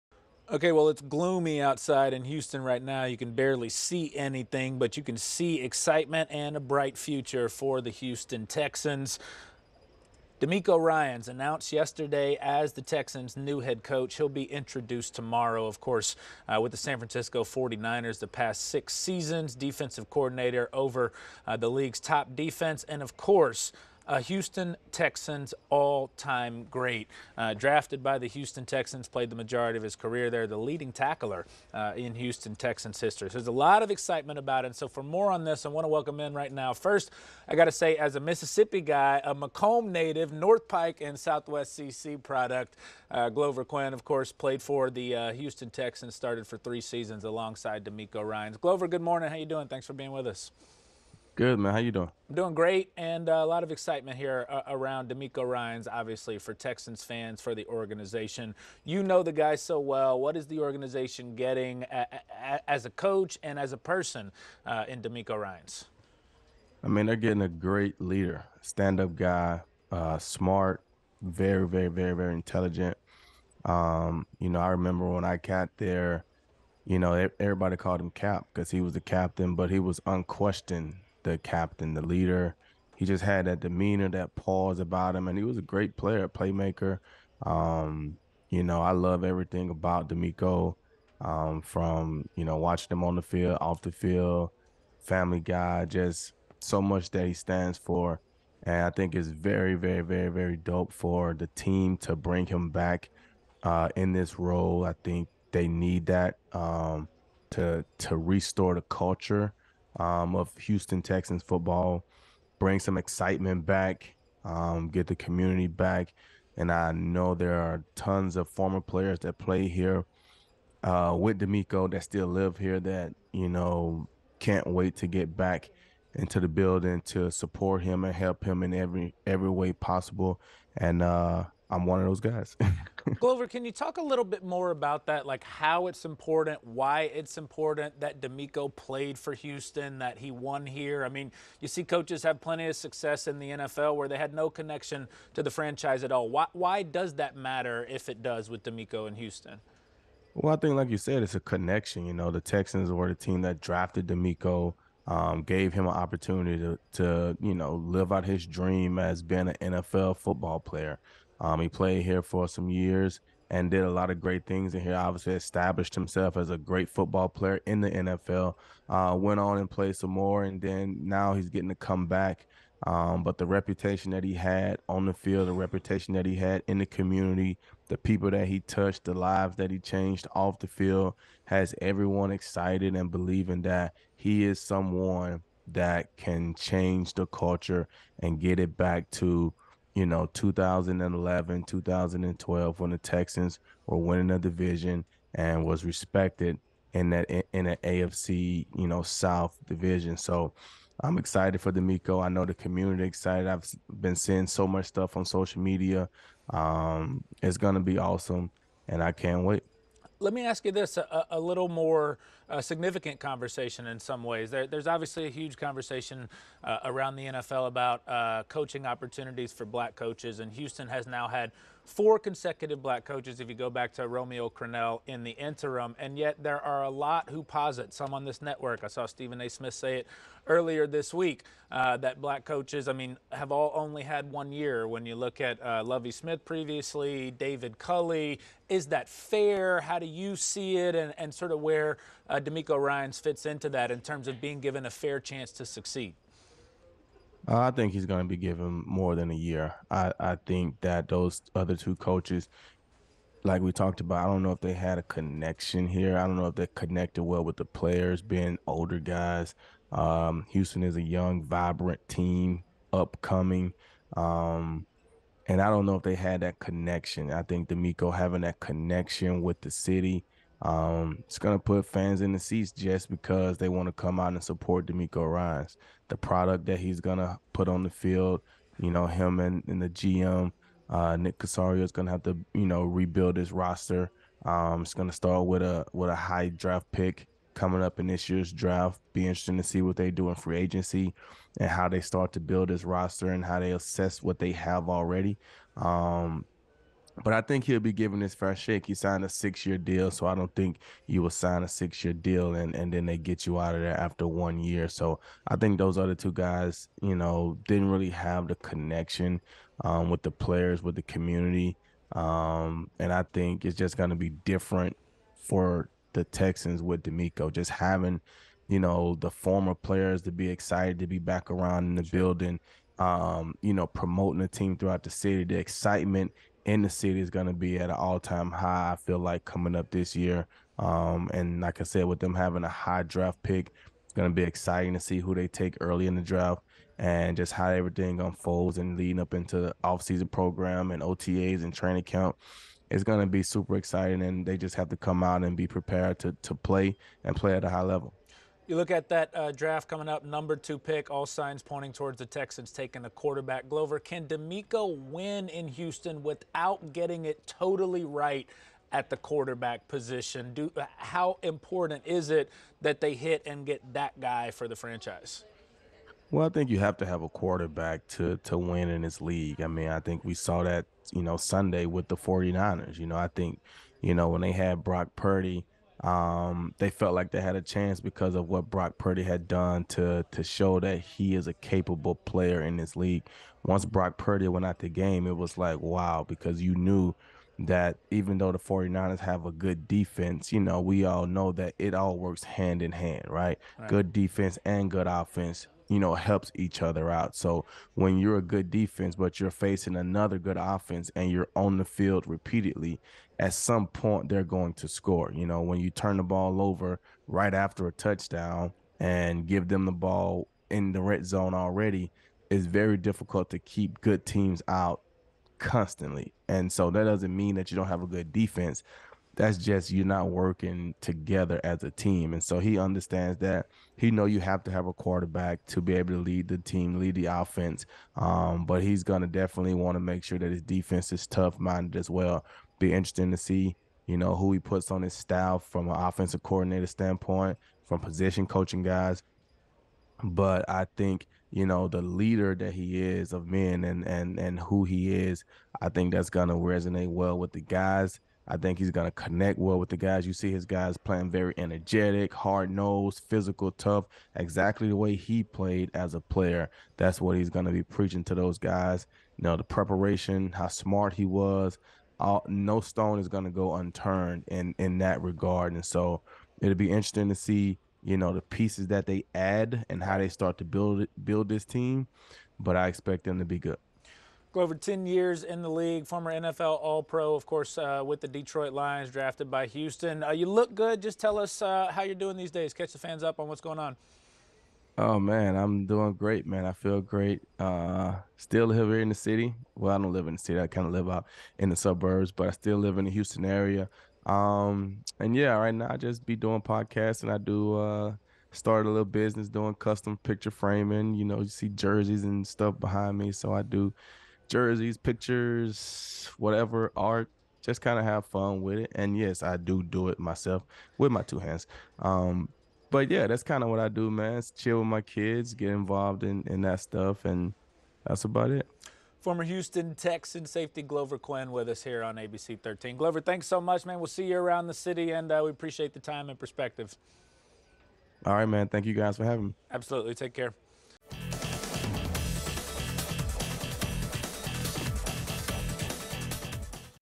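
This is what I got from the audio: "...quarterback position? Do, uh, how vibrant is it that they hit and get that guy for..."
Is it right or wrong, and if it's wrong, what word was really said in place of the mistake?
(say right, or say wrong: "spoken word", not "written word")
wrong: "important", not "vibrant".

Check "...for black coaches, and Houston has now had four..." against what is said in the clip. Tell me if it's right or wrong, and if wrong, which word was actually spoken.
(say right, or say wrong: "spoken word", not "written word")
right.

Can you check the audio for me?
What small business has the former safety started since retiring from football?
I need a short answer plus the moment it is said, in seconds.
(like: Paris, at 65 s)
Custom picture framing, at 499 s.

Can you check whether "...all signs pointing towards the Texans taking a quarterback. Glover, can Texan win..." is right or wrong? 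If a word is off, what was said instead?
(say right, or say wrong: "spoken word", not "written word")
wrong: "DeMeco", not "Texan".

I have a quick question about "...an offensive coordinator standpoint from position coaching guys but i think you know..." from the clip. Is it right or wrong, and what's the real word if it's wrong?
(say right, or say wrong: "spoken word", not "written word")
right.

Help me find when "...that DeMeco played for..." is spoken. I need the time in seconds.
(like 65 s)
138 s.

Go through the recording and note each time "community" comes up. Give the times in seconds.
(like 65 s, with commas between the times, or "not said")
115 s, 176 s, 202 s, 311 s.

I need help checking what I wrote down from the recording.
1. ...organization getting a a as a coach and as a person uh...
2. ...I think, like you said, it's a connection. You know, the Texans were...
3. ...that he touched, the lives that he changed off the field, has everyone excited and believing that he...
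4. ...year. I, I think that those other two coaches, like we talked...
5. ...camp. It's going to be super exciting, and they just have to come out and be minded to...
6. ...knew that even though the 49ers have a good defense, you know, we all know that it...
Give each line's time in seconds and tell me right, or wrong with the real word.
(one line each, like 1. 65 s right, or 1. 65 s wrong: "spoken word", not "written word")
1. 60 s right
2. 150 s right
3. 178 s right
4. 249 s right
5. 342 s wrong: "prepared", not "minded"
6. 386 s right.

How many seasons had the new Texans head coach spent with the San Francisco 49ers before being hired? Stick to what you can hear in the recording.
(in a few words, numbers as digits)
6.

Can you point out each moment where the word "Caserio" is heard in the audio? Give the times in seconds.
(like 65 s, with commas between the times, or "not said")
281 s.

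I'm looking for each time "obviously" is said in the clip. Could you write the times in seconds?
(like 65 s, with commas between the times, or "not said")
55 s, 164 s, 214 s.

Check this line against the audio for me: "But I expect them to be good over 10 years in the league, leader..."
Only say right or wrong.
wrong.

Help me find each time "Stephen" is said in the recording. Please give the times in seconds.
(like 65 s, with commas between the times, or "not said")
229 s.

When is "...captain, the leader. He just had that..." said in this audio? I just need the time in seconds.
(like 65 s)
81 s.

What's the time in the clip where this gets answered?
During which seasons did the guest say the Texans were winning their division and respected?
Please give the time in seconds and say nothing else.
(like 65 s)
190 s.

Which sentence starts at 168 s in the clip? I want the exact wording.
Uh, went on and played some more, and then now he's getting to come back.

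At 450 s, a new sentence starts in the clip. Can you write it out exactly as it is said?
You see his guys playing very energetic, hard nosed, physical, tough, exactly the way he played as a player.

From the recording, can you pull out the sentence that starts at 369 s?
I mean, I think we saw that, you know, Sunday with the 49ers.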